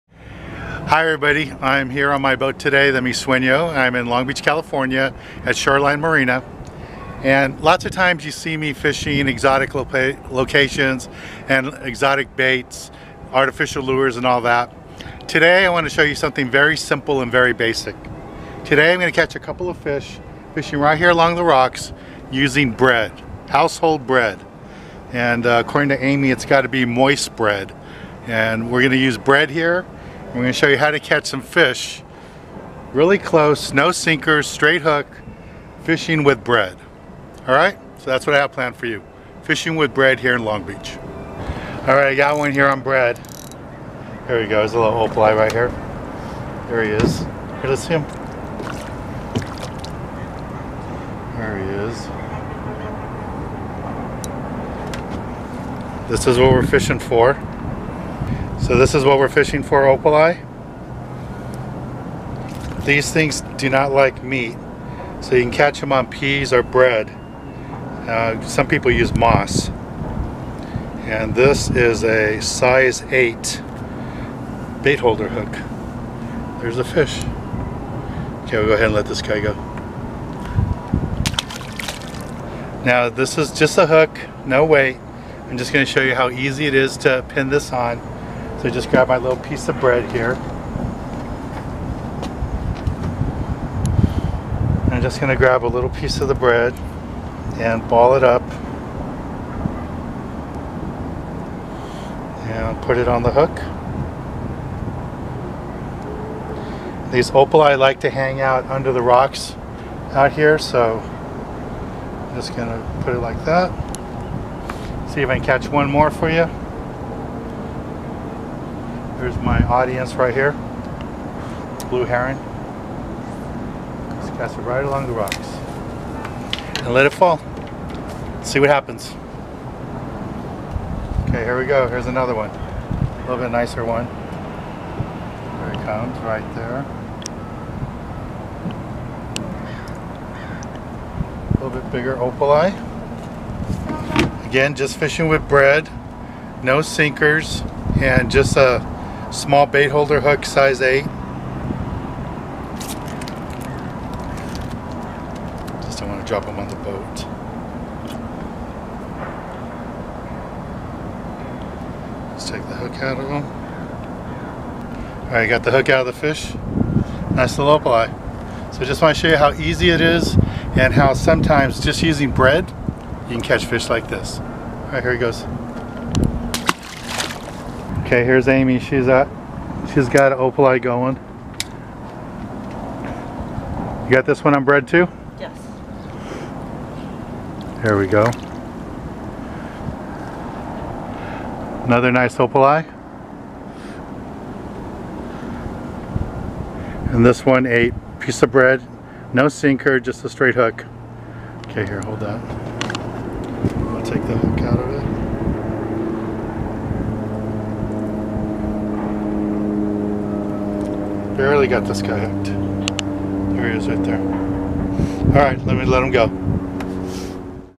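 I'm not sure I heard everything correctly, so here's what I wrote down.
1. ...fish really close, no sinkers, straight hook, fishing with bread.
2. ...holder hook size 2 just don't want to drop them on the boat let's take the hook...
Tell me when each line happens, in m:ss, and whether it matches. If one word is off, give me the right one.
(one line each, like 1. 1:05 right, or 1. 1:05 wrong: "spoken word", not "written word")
1. 0:31 right
2. 2:29 wrong: "8", not "2".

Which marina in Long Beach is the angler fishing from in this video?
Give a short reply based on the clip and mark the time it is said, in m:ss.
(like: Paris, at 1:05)
Shoreline Marina, at 0:05.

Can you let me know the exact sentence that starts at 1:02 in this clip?
These things do not like meat.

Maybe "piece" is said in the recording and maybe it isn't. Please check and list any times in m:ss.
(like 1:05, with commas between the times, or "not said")
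1:29, 1:35, 3:18.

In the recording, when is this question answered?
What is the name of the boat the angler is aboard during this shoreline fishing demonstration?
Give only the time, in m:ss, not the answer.
0:02.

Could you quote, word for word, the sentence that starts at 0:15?
Today I want to show you something very simple and very basic.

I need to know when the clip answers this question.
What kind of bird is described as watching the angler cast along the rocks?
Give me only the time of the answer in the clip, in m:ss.
2:01.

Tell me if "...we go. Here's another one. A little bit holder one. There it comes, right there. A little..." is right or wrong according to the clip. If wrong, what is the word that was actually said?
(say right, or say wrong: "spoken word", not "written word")
wrong: "nicer", not "holder".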